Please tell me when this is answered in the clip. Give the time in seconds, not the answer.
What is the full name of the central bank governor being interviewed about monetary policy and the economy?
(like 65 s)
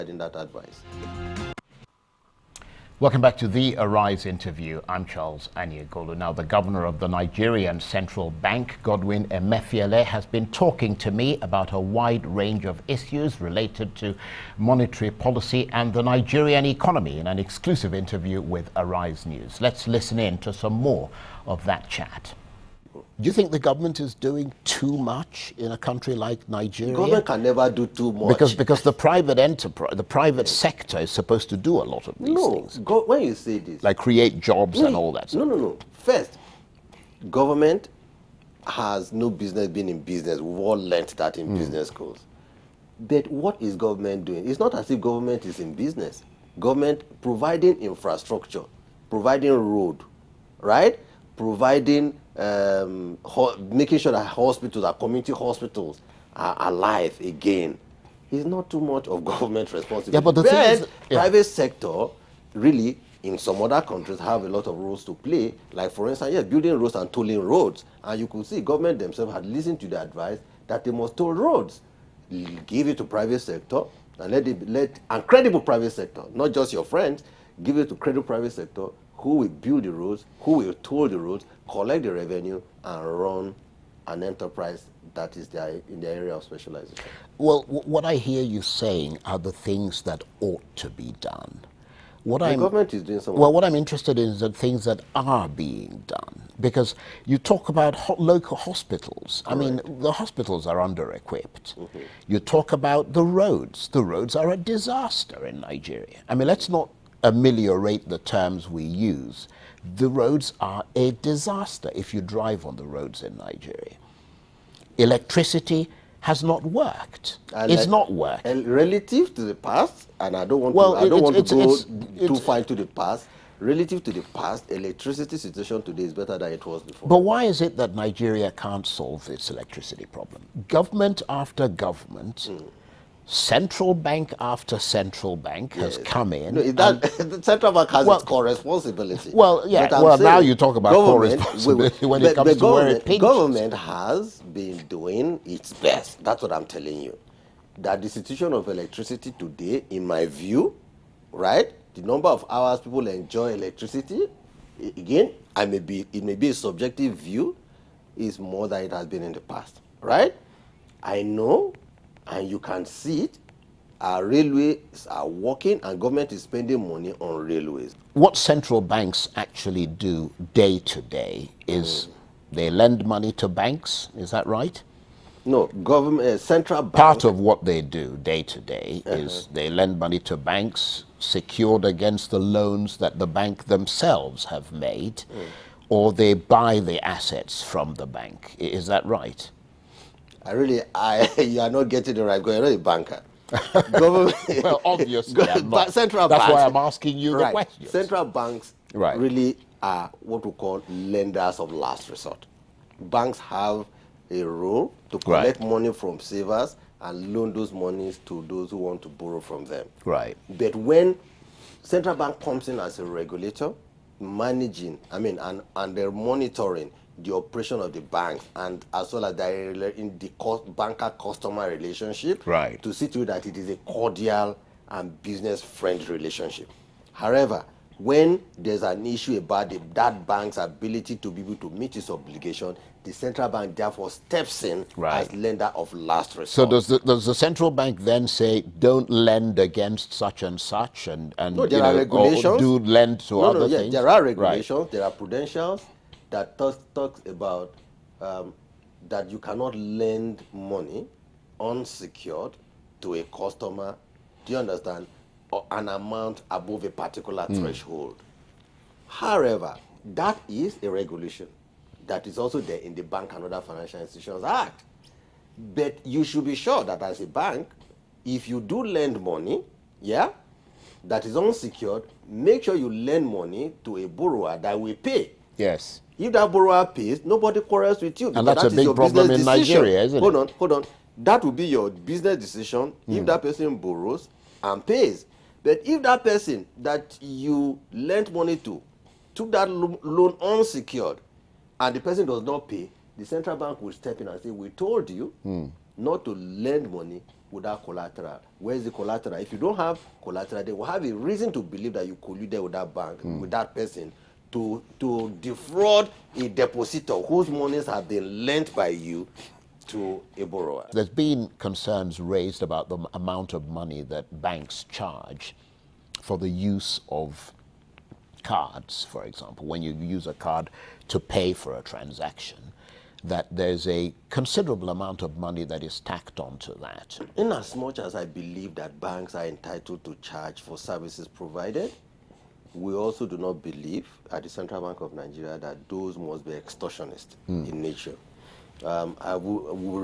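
8 s.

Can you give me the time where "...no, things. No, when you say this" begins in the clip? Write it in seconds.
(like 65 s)
32 s.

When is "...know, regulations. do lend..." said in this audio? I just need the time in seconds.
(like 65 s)
241 s.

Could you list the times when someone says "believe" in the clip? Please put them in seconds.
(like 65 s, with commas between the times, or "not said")
301 s, 328 s, 333 s.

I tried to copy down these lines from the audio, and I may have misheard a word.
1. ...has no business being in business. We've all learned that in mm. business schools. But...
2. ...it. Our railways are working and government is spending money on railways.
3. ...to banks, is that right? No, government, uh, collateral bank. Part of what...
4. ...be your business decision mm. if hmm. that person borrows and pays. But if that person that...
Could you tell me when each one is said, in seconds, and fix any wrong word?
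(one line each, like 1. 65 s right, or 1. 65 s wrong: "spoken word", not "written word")
1. 38 s right
2. 163 s right
3. 173 s wrong: "central", not "collateral"
4. 281 s right.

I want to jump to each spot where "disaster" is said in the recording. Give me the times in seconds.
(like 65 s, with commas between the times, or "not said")
104 s, 111 s.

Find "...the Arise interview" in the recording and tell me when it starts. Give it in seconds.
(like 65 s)
3 s.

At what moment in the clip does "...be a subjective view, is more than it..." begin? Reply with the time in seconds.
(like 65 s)
156 s.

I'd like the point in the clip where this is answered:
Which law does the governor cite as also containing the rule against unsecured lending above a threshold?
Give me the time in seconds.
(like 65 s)
263 s.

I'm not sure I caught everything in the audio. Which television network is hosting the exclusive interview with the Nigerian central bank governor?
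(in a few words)
Arise News.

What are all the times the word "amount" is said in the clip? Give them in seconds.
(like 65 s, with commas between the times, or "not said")
255 s, 313 s, 324 s.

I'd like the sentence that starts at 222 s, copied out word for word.
to see to that it is a cordial and business friendly relationship.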